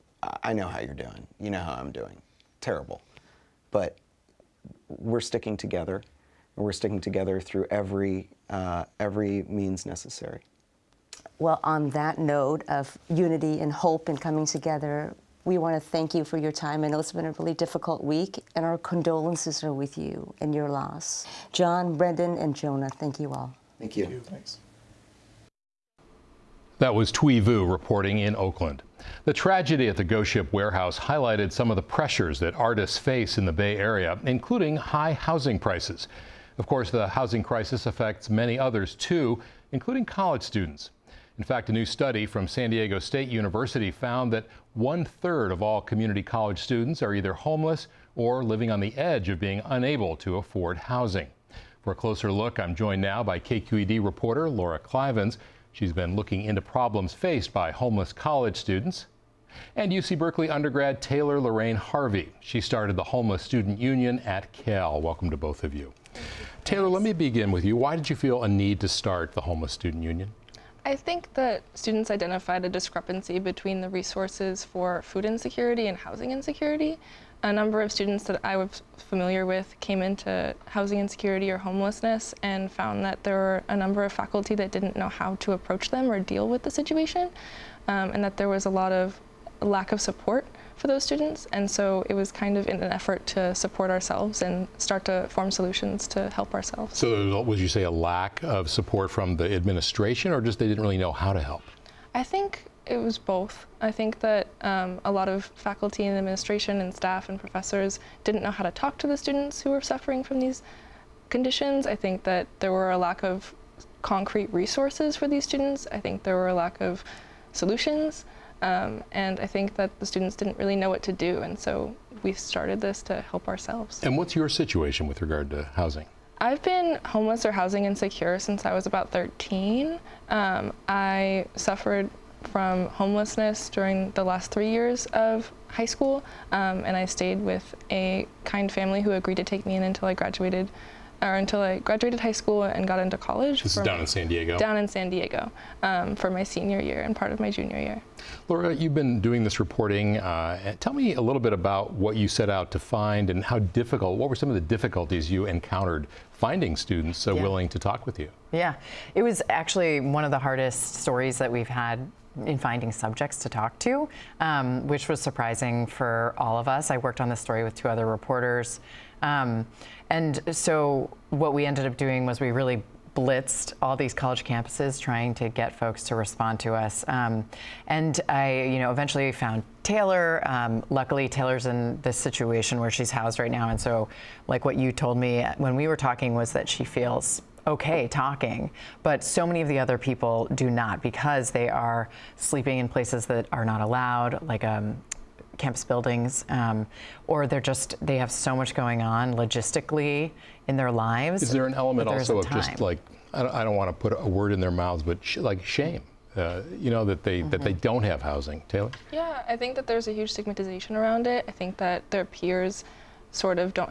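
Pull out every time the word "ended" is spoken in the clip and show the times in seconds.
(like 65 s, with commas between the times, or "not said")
171 s.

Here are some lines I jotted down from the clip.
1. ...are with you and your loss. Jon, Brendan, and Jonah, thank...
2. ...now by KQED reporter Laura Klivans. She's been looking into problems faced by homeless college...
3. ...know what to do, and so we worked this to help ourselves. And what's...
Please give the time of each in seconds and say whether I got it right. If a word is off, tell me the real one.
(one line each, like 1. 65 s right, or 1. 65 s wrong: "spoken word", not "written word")
1. 19 s right
2. 53 s right
3. 120 s wrong: "started", not "worked".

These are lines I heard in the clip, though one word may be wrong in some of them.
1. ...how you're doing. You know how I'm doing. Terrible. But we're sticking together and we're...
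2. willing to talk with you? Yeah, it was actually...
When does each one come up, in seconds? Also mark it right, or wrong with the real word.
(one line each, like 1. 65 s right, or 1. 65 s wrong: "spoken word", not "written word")
1. 0 s right
2. 157 s right.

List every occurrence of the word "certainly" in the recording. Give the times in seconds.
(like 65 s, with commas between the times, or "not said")
not said.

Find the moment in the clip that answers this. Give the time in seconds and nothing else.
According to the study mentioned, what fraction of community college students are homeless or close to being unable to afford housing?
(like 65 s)
44 s.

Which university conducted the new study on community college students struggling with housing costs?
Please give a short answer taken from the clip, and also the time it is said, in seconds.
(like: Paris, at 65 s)
San Diego State University, at 42 s.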